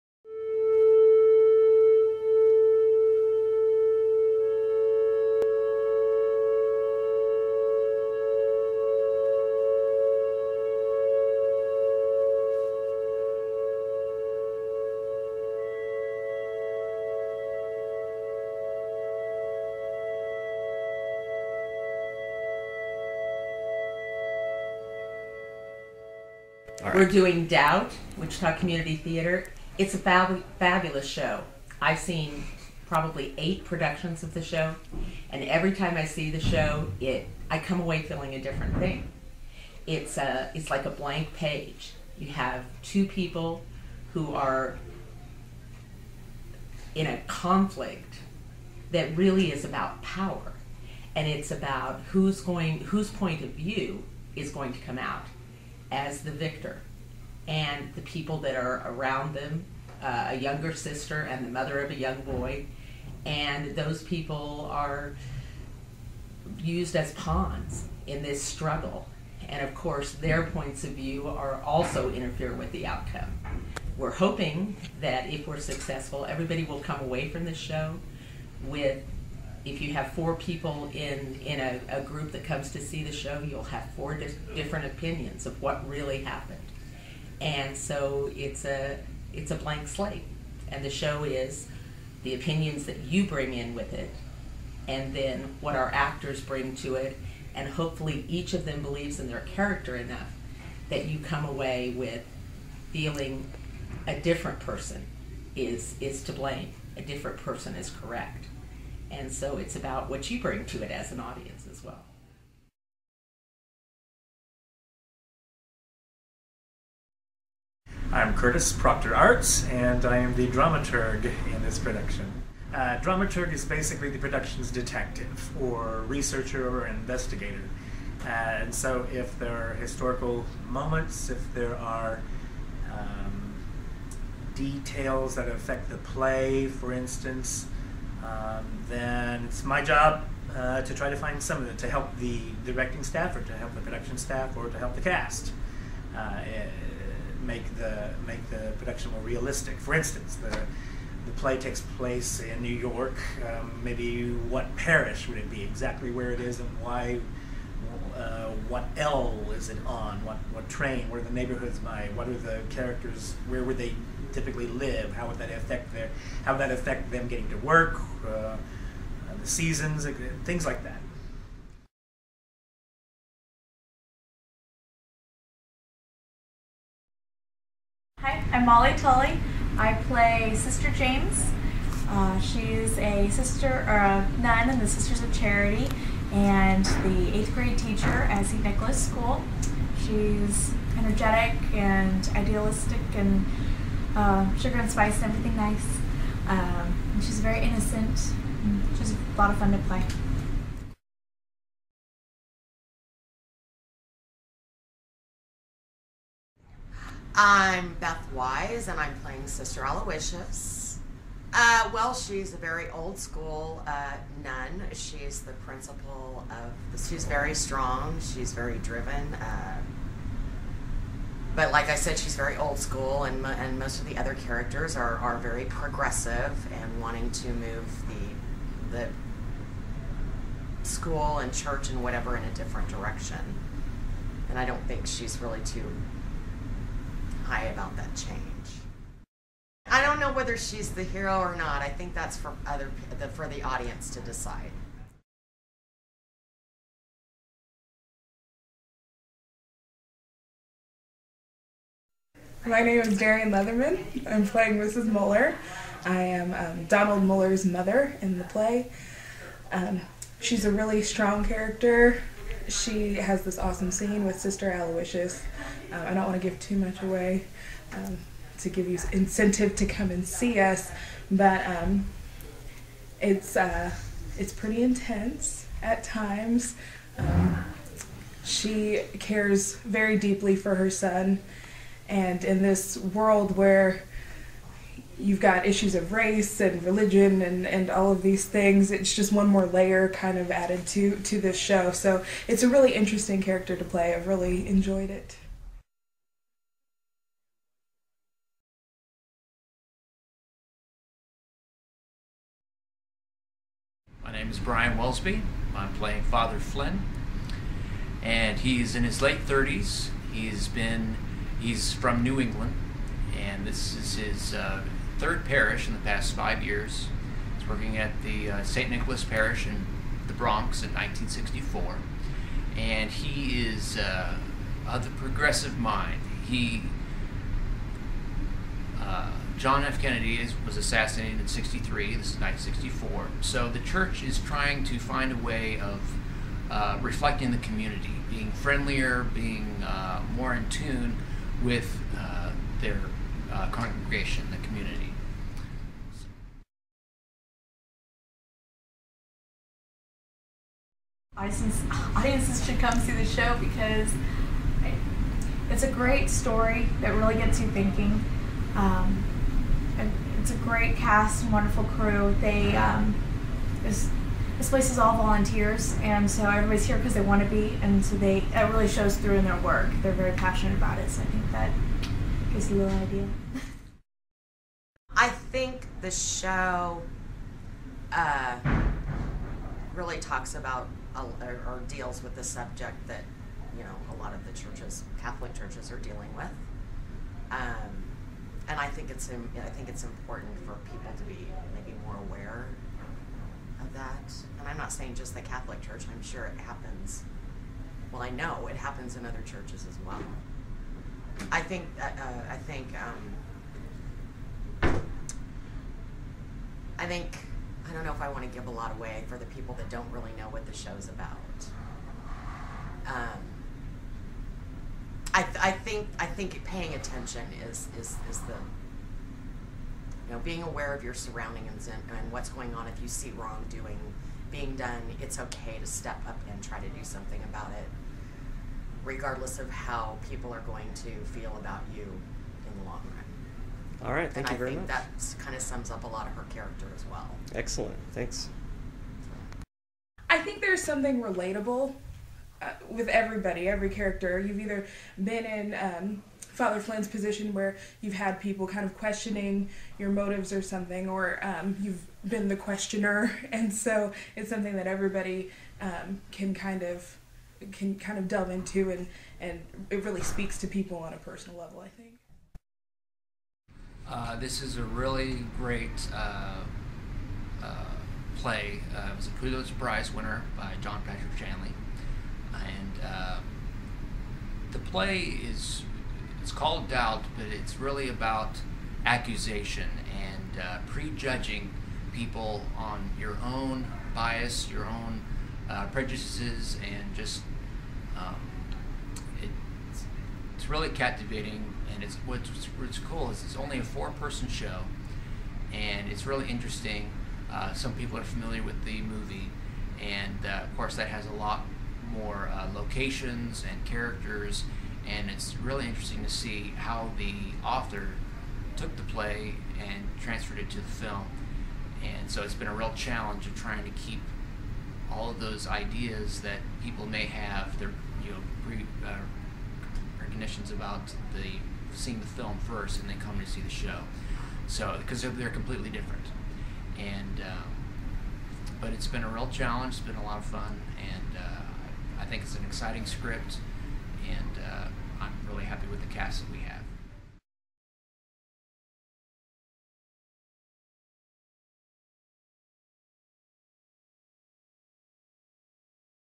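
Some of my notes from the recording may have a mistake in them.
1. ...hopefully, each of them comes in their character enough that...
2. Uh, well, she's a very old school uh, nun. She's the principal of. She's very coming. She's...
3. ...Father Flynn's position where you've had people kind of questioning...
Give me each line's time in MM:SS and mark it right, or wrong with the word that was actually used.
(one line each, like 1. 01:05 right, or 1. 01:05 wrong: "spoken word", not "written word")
1. 01:37 wrong: "believes", not "comes"
2. 03:31 wrong: "strong", not "coming"
3. 07:26 right.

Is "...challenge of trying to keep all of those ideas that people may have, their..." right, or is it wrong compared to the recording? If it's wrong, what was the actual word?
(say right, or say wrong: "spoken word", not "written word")
right.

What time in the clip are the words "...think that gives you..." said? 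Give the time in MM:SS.
06:11.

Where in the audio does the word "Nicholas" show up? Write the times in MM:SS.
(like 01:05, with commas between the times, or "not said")
03:08, 05:18.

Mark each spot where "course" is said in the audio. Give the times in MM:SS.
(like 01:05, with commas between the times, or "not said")
01:09, 08:20.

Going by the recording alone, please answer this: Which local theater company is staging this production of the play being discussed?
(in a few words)
Wichita Community Theater.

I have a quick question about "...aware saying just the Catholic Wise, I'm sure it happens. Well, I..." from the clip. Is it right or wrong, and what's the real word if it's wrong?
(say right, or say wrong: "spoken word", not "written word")
wrong: "Church", not "Wise".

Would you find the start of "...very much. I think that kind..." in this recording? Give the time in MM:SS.
07:14.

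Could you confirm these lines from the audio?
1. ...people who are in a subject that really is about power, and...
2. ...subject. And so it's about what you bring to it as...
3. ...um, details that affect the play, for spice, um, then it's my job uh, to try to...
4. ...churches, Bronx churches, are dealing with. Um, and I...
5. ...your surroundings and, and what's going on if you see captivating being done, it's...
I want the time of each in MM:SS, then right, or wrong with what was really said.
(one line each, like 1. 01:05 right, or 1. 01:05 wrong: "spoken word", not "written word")
1. 00:43 wrong: "conflict", not "subject"
2. 01:47 wrong: "correct", not "subject"
3. 02:12 wrong: "instance", not "spice"
4. 06:24 wrong: "Catholic", not "Bronx"
5. 07:01 wrong: "wrongdoing", not "captivating".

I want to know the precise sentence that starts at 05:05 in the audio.
I'm playing Father Flynn, and he's in his late 30s.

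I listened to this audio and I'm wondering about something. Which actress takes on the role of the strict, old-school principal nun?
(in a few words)
Beth Wise.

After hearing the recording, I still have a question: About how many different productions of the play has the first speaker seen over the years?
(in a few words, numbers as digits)
8.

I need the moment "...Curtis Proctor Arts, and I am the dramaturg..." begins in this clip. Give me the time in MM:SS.
01:58.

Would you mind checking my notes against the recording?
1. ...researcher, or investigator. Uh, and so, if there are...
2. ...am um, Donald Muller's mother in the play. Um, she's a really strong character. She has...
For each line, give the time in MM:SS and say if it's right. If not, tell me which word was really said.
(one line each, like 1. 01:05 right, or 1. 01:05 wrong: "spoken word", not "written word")
1. 02:06 right
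2. 04:16 right.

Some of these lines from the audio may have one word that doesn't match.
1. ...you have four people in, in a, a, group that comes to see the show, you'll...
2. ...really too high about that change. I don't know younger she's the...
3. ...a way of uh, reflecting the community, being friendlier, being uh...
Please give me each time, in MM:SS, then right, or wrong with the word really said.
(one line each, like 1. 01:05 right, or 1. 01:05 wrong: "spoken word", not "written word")
1. 01:19 right
2. 03:55 wrong: "whether", not "younger"
3. 05:35 right.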